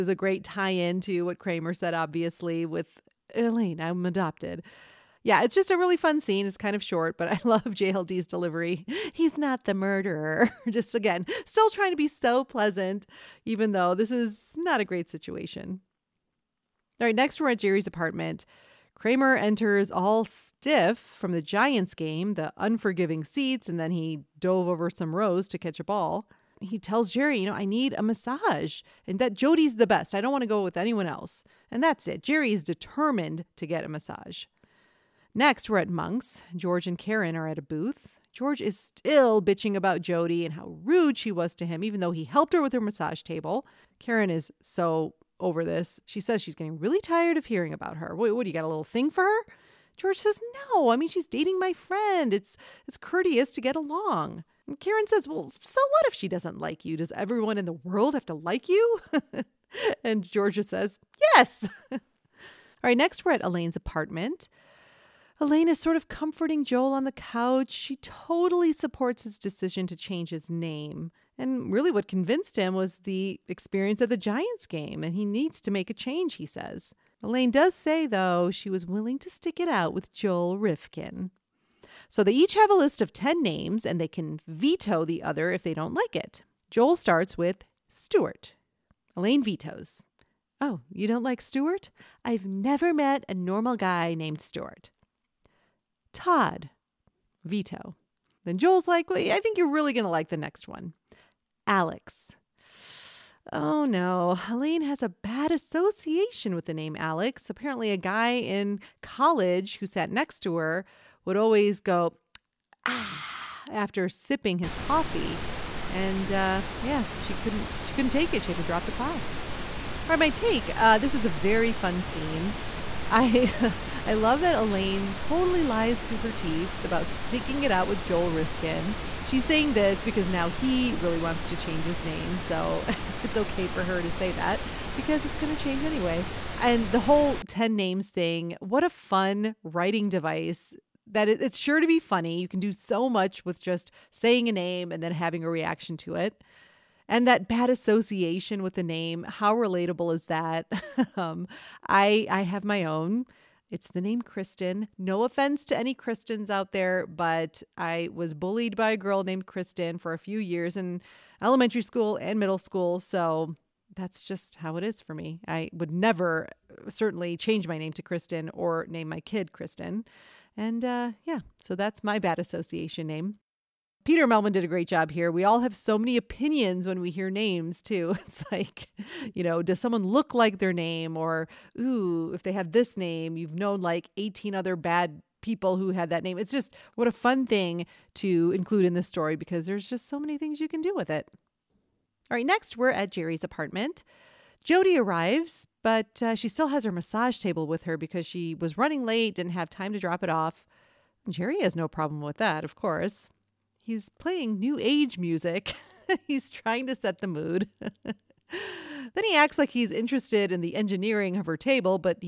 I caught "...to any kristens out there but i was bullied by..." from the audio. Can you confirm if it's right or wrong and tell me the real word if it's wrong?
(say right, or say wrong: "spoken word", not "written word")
right.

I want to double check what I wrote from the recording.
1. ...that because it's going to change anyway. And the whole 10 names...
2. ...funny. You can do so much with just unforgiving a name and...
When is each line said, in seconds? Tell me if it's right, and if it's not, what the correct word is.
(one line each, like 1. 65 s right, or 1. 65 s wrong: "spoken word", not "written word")
1. 134 s right
2. 141 s wrong: "saying", not "unforgiving".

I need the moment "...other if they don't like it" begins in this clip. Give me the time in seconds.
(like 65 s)
85 s.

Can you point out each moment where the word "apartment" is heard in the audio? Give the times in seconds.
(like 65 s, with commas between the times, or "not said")
17 s, 63 s, 193 s.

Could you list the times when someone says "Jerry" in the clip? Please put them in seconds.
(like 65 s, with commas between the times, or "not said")
17 s, 27 s, 32 s, 193 s, 201 s.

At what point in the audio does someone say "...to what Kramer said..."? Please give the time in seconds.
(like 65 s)
1 s.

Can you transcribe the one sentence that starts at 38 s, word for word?
George is still bitching about Jody and how rude she was to him, even though he helped her with her massage table.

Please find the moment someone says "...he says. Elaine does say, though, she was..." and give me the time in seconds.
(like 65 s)
76 s.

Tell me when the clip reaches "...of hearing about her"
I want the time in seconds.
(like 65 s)
47 s.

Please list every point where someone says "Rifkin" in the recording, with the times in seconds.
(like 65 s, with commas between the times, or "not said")
80 s, 128 s.